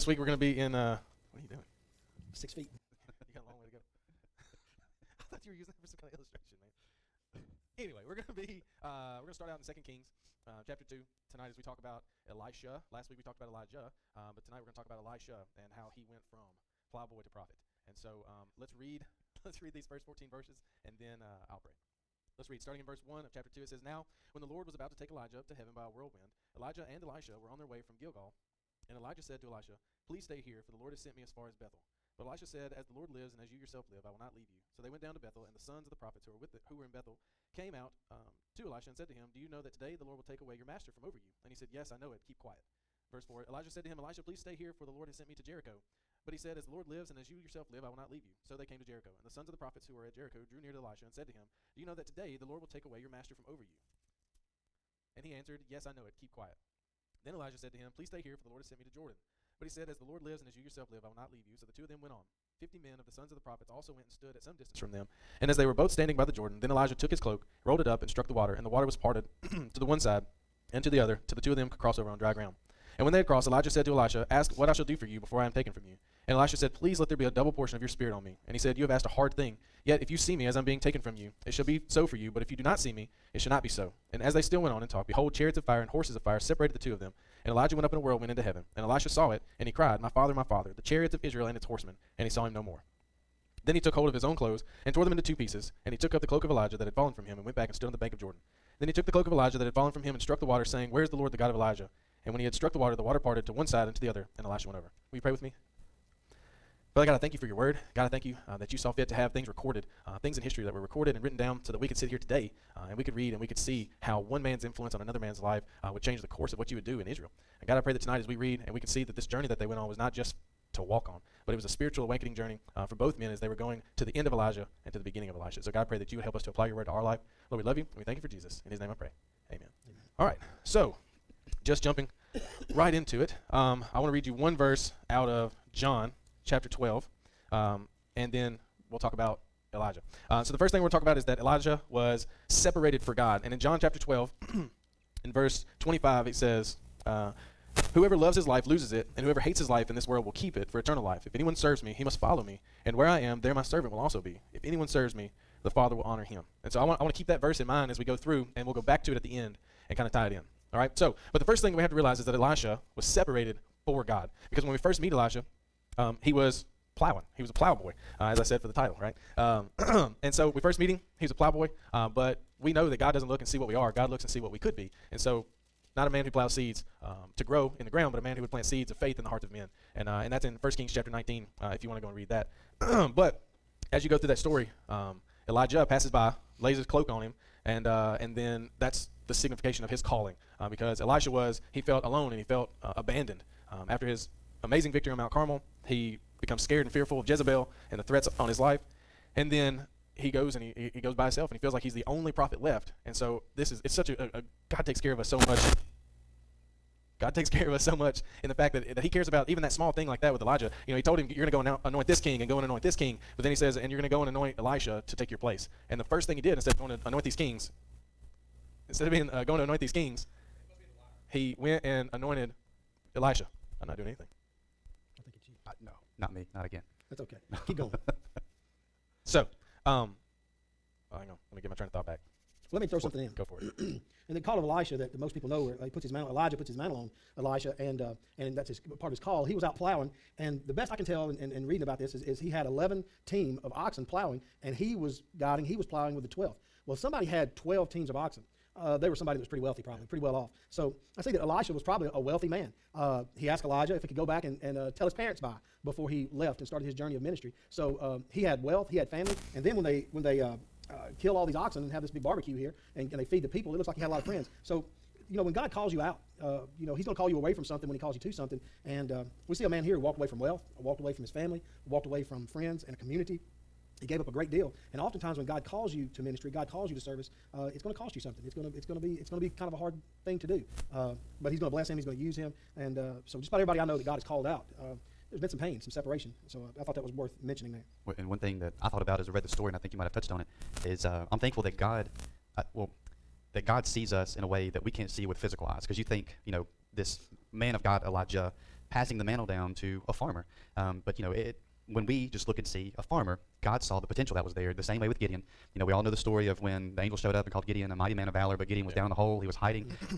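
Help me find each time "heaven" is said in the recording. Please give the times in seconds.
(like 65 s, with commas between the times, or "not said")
25 s, 88 s.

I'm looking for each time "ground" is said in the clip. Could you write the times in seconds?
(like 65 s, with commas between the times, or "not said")
72 s, 177 s.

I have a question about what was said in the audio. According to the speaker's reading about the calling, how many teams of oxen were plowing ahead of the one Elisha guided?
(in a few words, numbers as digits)
11.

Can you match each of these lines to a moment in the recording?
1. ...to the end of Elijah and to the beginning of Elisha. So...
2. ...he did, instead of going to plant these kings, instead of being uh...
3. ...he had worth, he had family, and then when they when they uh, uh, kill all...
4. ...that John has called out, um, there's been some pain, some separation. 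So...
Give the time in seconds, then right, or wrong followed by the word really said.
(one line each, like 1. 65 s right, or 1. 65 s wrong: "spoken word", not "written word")
1. 123 s right
2. 216 s wrong: "anoint", not "plant"
3. 258 s wrong: "wealth", not "worth"
4. 283 s wrong: "God", not "John".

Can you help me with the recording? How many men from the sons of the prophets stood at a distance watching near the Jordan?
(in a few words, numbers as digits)
50.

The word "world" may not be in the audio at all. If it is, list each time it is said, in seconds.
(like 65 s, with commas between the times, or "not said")
150 s.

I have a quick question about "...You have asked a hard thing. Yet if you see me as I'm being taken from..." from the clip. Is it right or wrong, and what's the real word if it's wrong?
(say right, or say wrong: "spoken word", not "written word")
right.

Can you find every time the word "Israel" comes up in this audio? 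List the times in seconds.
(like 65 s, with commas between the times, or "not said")
91 s, 117 s.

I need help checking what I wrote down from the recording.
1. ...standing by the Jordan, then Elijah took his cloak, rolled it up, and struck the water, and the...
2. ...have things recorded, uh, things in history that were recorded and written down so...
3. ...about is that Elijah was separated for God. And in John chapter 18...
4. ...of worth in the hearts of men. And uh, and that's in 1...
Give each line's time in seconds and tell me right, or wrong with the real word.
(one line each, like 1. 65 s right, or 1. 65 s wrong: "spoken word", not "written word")
1. 65 s right
2. 109 s right
3. 141 s wrong: "12", not "18"
4. 178 s wrong: "faith", not "worth".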